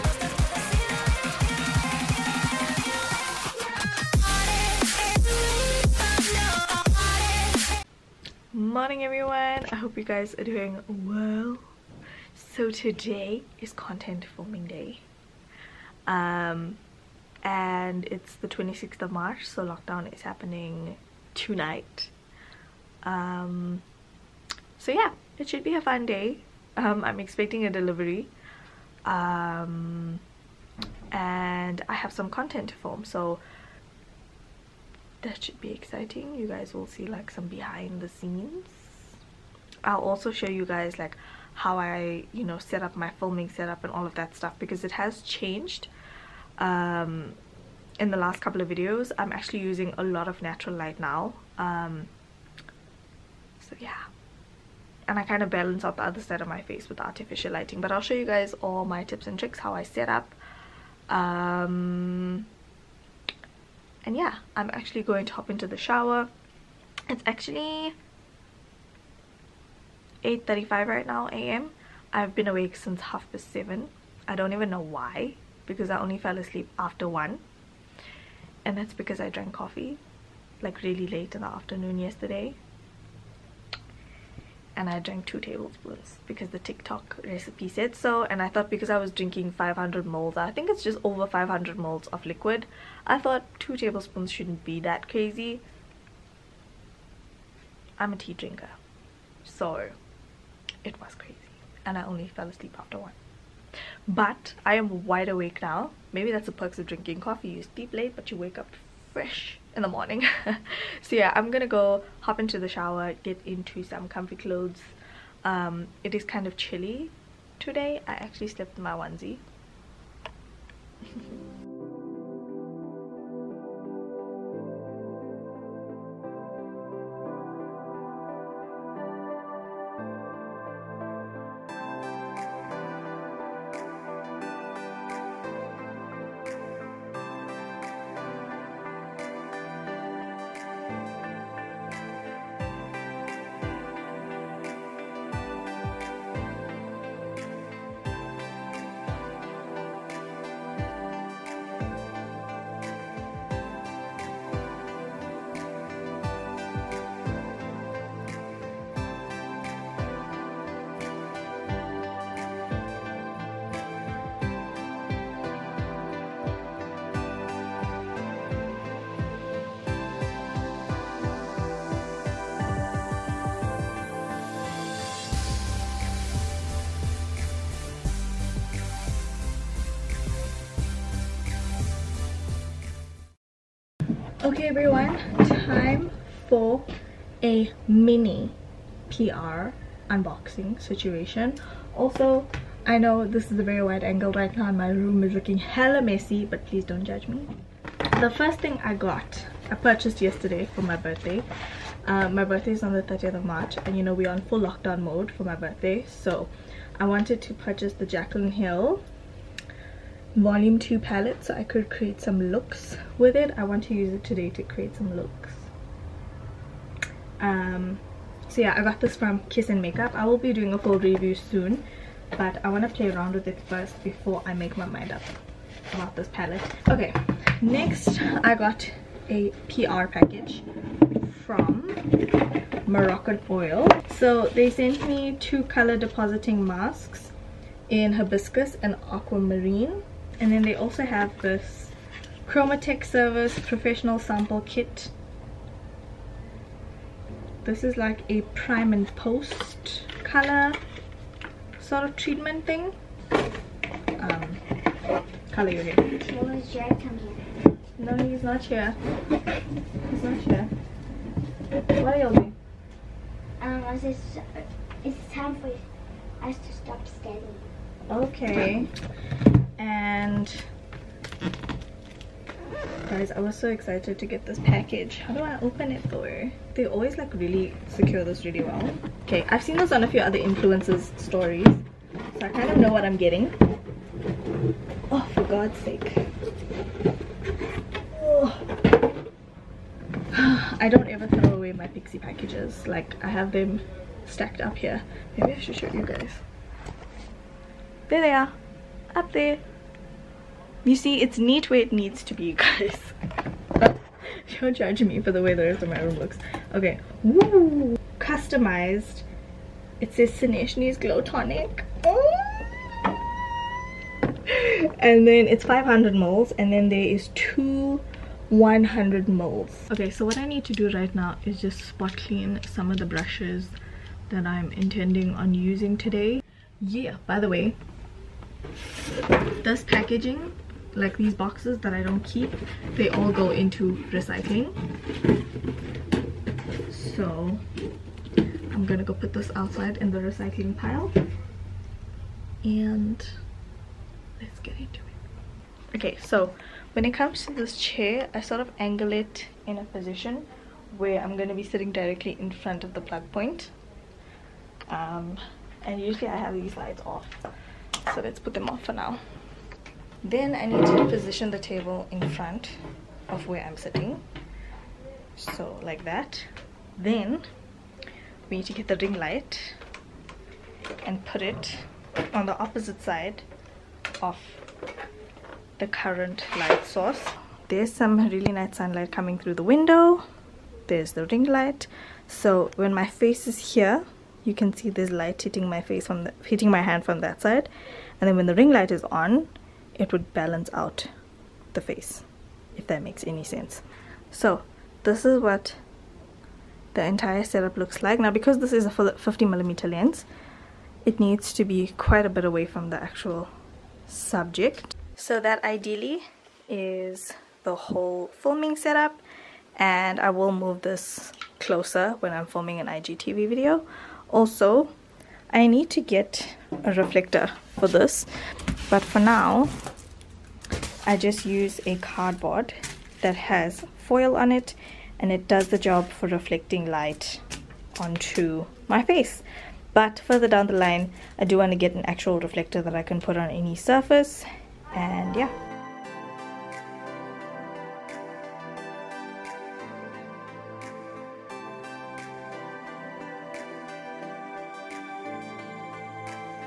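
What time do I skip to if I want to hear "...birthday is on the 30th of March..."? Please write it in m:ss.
3:22.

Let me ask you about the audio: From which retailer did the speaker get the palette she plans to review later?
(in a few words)
Kiss and Makeup.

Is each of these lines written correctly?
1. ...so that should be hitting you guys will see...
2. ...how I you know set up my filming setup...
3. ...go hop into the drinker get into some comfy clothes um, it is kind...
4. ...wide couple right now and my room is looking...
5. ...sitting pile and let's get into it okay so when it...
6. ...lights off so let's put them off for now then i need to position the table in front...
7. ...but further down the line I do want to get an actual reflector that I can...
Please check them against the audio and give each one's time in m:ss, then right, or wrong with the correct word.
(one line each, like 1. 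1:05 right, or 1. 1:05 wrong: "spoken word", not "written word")
1. 0:33 wrong: "exciting", not "hitting"
2. 0:41 right
3. 1:51 wrong: "shower", not "drinker"
4. 3:13 wrong: "angle", not "couple"
5. 5:40 wrong: "recycling", not "sitting"
6. 5:56 right
7. 7:09 right.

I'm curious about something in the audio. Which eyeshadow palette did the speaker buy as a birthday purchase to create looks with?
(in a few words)
Jaclyn Hill volume 2.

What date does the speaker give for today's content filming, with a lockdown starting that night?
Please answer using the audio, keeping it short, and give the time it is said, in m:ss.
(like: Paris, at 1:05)
26th of March, at 0:18.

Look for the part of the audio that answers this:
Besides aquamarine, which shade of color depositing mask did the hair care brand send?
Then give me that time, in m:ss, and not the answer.
3:58.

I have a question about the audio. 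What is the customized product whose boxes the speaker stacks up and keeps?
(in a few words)
Saneshnie's Glow Tonic.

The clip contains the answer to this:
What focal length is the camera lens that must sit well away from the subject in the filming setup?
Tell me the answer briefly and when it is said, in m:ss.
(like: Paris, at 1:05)
50 millimeter, at 6:38.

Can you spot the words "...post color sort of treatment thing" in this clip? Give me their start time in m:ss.
4:09.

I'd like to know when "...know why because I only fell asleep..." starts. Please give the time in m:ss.
1:14.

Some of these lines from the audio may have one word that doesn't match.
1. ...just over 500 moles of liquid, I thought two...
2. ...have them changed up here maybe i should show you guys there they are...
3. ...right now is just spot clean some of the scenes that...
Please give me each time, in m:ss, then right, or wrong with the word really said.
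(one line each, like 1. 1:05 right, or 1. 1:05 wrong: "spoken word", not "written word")
1. 1:30 right
2. 4:53 wrong: "stacked", not "changed"
3. 5:20 wrong: "brushes", not "scenes".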